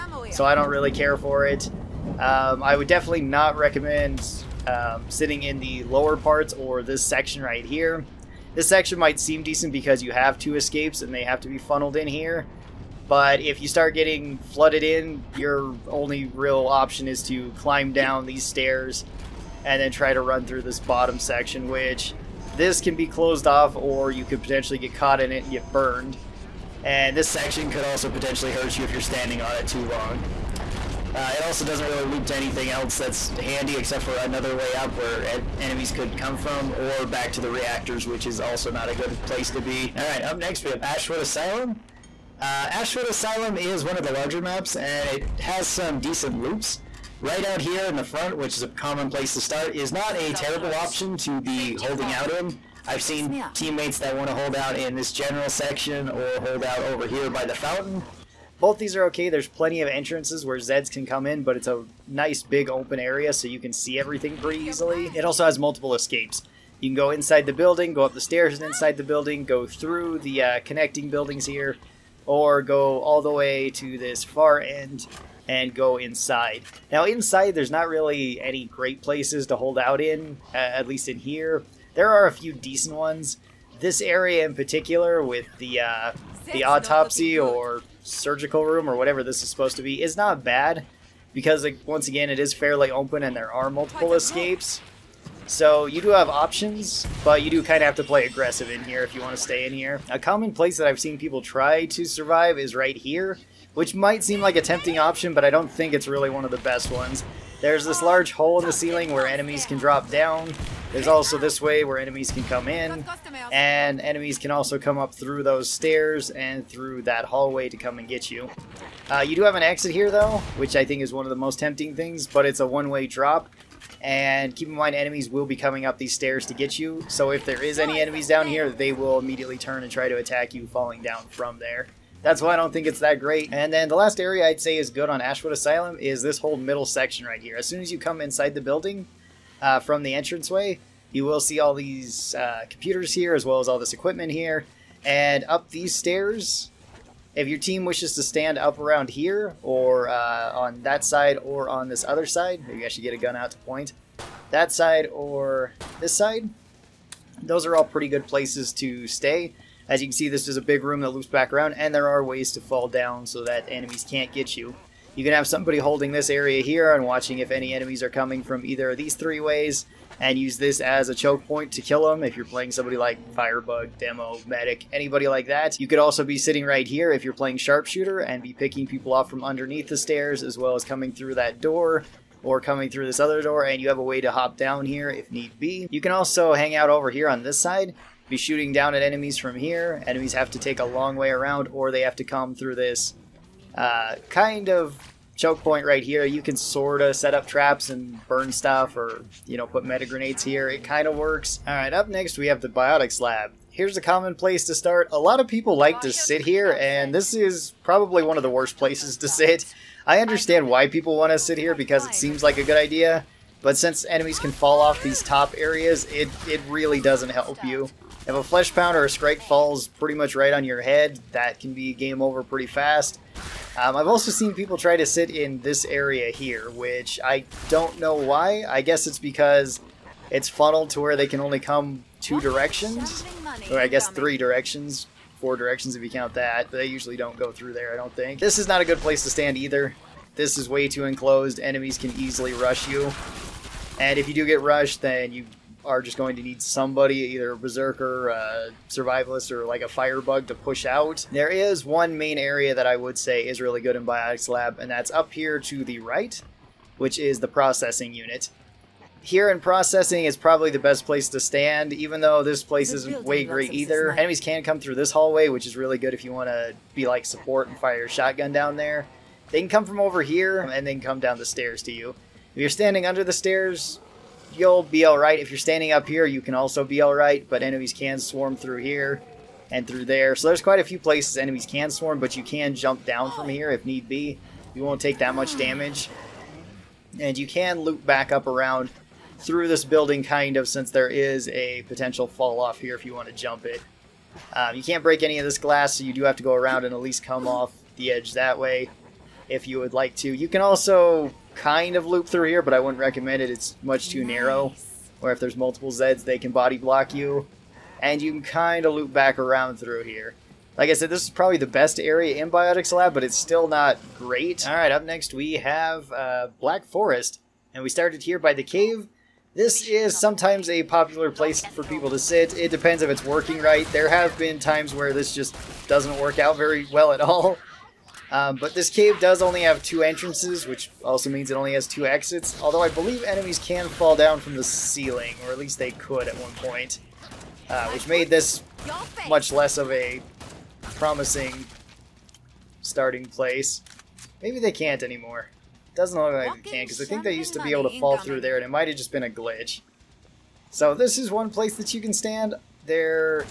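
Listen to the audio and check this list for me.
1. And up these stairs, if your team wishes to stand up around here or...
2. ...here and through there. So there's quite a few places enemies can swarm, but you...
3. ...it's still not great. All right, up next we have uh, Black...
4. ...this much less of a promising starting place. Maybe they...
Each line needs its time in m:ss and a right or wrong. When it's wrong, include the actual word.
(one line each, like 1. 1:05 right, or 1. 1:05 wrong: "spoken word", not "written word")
1. 2:25 right
2. 4:38 right
3. 5:13 right
4. 5:38 right.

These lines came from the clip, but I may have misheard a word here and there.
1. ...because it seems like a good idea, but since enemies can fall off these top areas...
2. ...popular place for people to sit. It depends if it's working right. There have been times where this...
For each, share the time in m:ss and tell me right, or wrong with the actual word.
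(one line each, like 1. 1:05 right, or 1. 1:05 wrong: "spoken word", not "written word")
1. 3:31 right
2. 5:20 right.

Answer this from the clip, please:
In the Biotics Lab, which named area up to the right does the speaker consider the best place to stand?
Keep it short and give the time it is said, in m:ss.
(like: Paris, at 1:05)
Processing unit, at 4:17.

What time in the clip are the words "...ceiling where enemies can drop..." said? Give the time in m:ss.
1:48.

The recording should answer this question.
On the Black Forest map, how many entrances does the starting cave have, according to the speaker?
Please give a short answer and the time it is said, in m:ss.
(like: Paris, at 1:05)
2, at 5:29.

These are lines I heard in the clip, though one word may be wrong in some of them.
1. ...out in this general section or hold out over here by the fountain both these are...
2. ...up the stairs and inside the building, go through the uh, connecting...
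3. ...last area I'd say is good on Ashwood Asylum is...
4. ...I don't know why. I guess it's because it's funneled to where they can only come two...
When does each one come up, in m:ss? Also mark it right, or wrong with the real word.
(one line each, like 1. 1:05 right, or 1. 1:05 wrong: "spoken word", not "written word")
1. 0:54 right
2. 1:08 right
3. 2:13 right
4. 3:47 right.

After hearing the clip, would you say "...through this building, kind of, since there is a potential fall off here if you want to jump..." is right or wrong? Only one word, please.
right.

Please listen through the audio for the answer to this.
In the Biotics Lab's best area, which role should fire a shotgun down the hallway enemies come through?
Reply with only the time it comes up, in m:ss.
4:27.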